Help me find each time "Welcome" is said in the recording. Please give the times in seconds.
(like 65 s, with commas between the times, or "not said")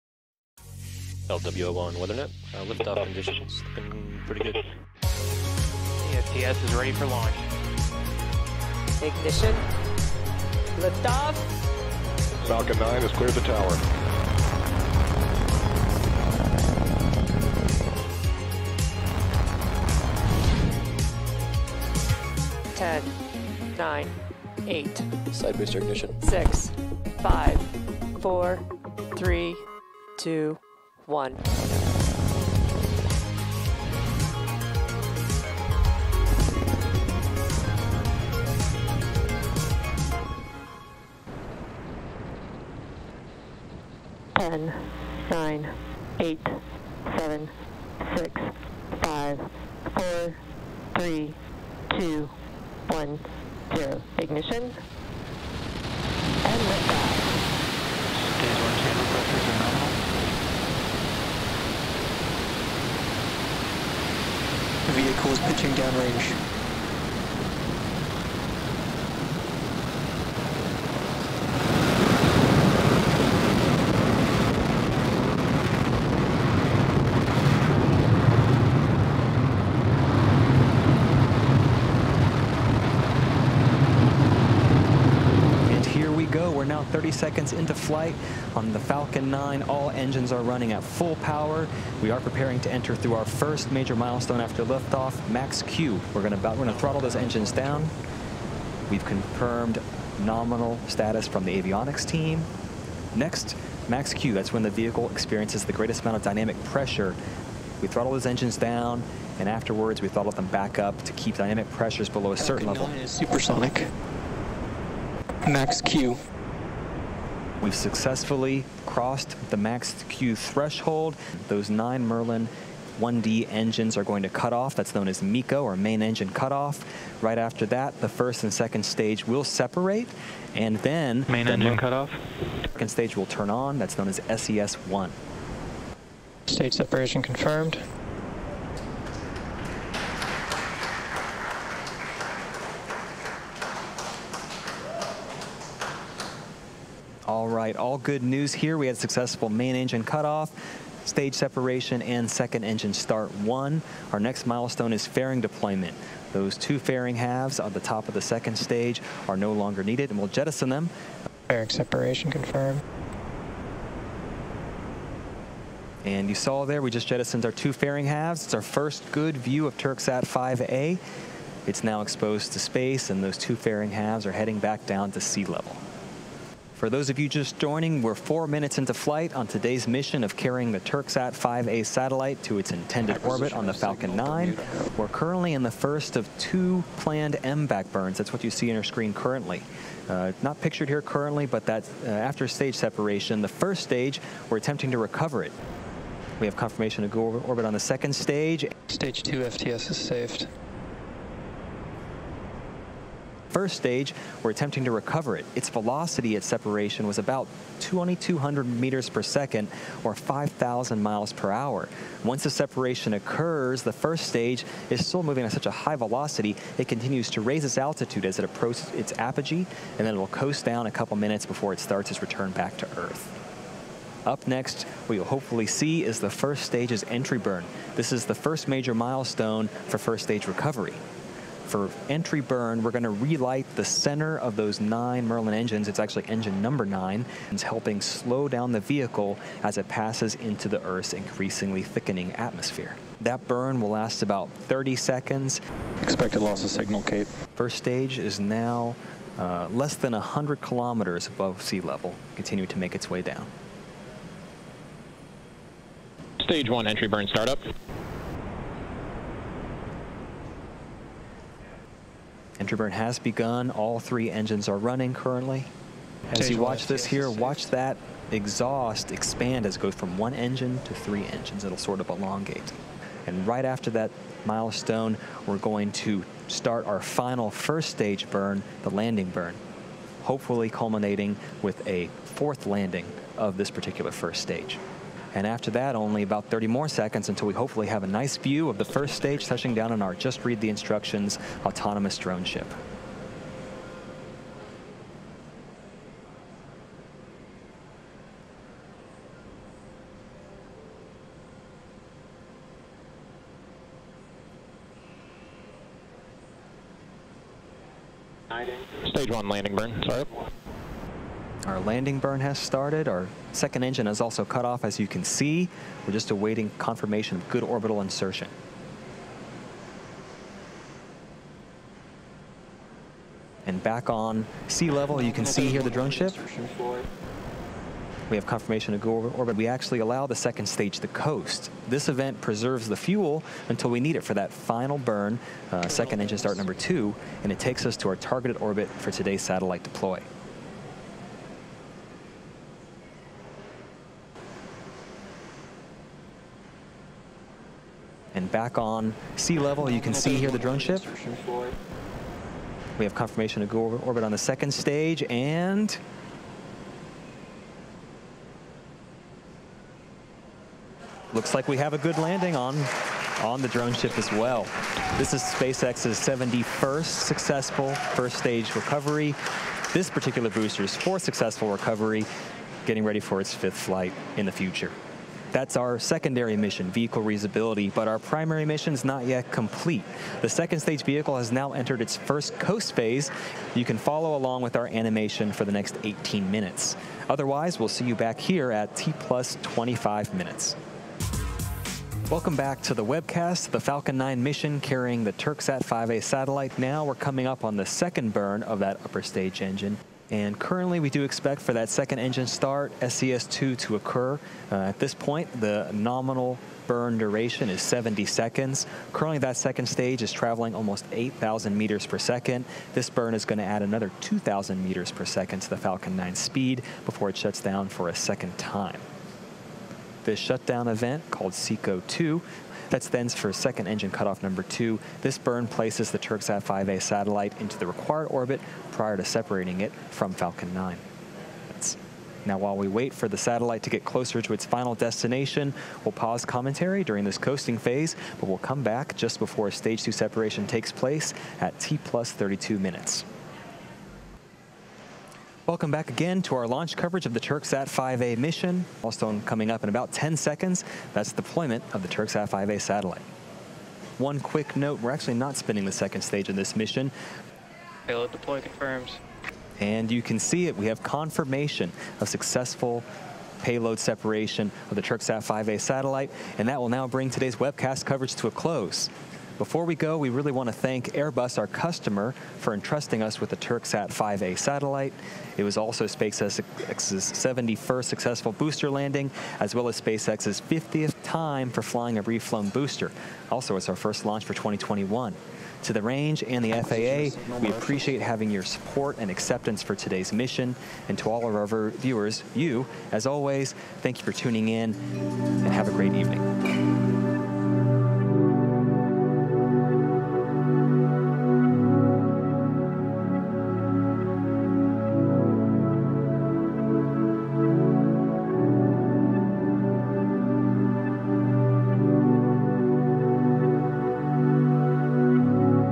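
392 s, 445 s.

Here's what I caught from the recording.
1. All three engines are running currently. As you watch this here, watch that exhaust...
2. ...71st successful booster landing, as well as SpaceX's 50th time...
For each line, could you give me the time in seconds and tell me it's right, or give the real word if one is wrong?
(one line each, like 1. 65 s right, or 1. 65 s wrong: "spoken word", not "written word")
1. 263 s right
2. 476 s right.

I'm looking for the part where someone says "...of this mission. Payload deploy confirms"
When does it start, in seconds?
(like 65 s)
456 s.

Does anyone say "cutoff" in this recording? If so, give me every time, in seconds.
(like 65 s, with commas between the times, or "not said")
126 s, 131 s, 150 s, 424 s.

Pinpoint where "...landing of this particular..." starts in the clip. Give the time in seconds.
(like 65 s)
282 s.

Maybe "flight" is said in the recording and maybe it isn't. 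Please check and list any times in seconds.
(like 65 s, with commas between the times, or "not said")
87 s, 178 s, 373 s.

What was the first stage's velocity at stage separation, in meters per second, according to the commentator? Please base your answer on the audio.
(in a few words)
2,200.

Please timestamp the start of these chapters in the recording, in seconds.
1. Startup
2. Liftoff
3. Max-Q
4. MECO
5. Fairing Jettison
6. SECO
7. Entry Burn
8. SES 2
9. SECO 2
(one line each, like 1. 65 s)
1. 46 s
2. 58 s
3. 116 s
4. 132 s
5. 162 s
6. 200 s
7. 257 s
8. 403 s
9. 426 s.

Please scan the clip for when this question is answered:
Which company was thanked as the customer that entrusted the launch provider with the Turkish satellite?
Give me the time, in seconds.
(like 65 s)
471 s.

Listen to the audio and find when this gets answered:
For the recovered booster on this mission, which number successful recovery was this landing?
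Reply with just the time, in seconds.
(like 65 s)
370 s.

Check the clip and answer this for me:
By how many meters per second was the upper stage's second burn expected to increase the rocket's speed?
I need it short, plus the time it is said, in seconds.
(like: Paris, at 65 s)
2,000, at 414 s.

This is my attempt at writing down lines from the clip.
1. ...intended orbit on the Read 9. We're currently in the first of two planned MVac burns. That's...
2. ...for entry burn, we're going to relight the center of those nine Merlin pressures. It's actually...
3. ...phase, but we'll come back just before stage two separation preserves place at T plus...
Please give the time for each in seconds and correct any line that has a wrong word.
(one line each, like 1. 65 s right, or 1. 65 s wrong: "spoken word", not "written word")
1. 182 s wrong: "Falcon", not "Read"
2. 231 s wrong: "engines", not "pressures"
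3. 437 s wrong: "takes", not "preserves".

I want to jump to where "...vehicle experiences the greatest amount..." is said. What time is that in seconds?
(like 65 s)
104 s.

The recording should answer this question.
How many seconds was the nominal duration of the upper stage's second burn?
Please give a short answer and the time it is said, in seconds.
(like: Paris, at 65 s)
70, at 407 s.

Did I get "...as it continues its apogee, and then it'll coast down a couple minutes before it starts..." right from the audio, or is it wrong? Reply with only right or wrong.
wrong.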